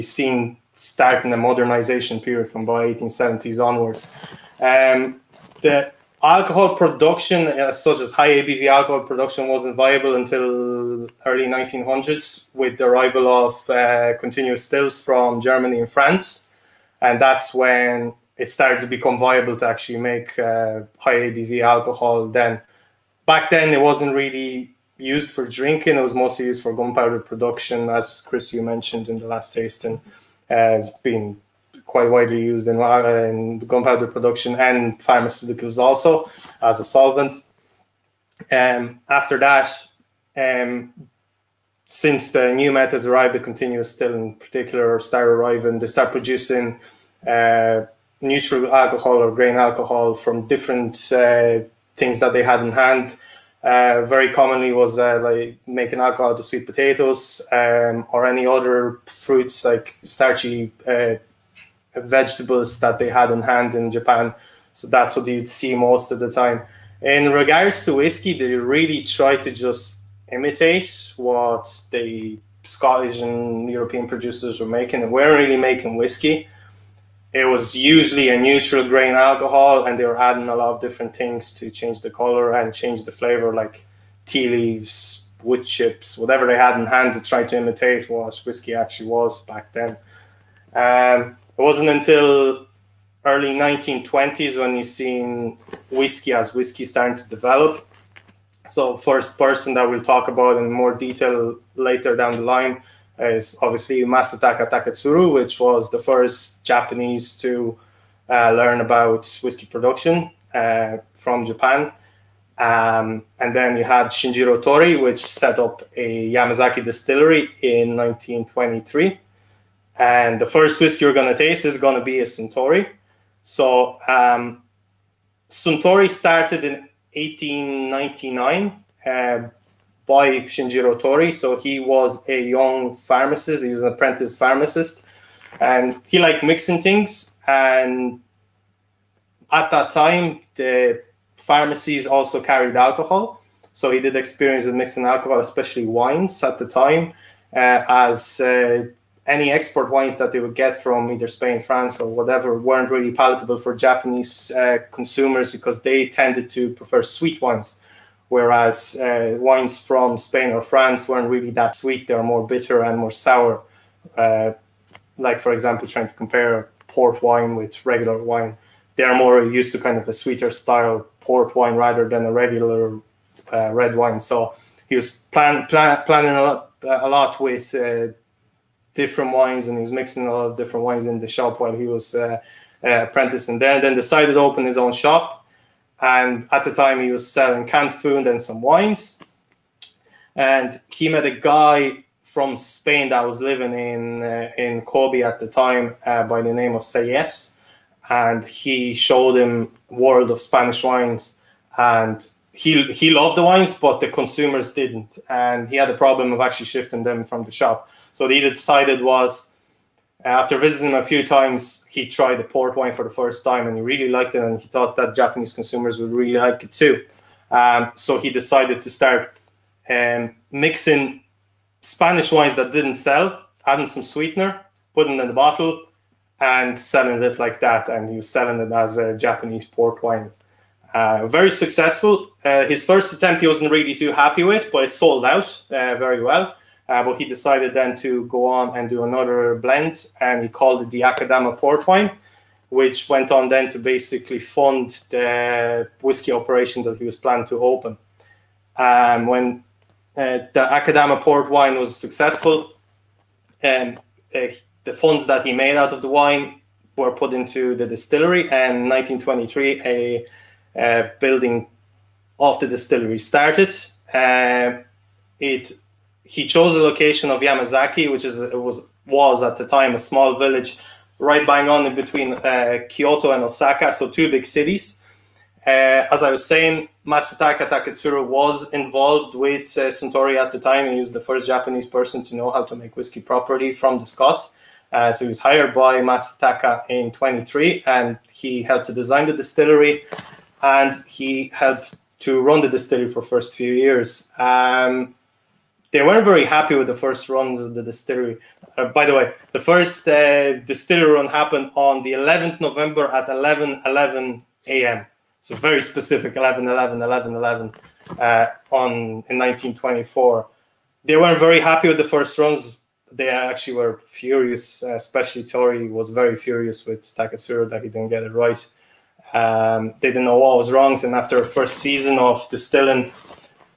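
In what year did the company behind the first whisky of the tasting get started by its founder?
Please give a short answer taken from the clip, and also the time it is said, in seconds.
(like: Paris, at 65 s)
1899, at 127 s.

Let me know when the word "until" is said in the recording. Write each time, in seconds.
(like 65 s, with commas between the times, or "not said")
10 s, 91 s.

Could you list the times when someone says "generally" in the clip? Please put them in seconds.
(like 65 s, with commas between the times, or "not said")
not said.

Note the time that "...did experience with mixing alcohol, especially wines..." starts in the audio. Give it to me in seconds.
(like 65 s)
144 s.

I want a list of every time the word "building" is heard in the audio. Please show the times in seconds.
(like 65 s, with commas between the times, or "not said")
261 s.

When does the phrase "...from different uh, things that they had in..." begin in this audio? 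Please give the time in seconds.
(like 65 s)
50 s.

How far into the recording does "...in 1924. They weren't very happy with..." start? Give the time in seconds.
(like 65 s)
309 s.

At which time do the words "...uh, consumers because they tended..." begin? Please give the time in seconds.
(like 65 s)
154 s.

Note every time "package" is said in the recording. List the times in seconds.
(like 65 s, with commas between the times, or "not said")
not said.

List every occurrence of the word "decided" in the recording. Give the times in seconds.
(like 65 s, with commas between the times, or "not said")
183 s, 208 s, 218 s, 237 s.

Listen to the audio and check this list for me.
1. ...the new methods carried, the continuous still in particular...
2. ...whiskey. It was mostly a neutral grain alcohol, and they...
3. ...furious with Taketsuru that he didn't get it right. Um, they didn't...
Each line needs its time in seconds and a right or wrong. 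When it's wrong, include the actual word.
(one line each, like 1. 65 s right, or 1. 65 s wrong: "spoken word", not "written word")
1. 42 s wrong: "arrived", not "carried"
2. 75 s wrong: "usually", not "mostly"
3. 316 s right.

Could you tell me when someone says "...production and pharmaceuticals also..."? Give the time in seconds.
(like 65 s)
34 s.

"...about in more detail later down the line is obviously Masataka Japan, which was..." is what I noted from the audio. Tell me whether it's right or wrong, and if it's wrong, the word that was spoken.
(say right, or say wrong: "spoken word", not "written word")
wrong: "Taketsuru", not "Japan".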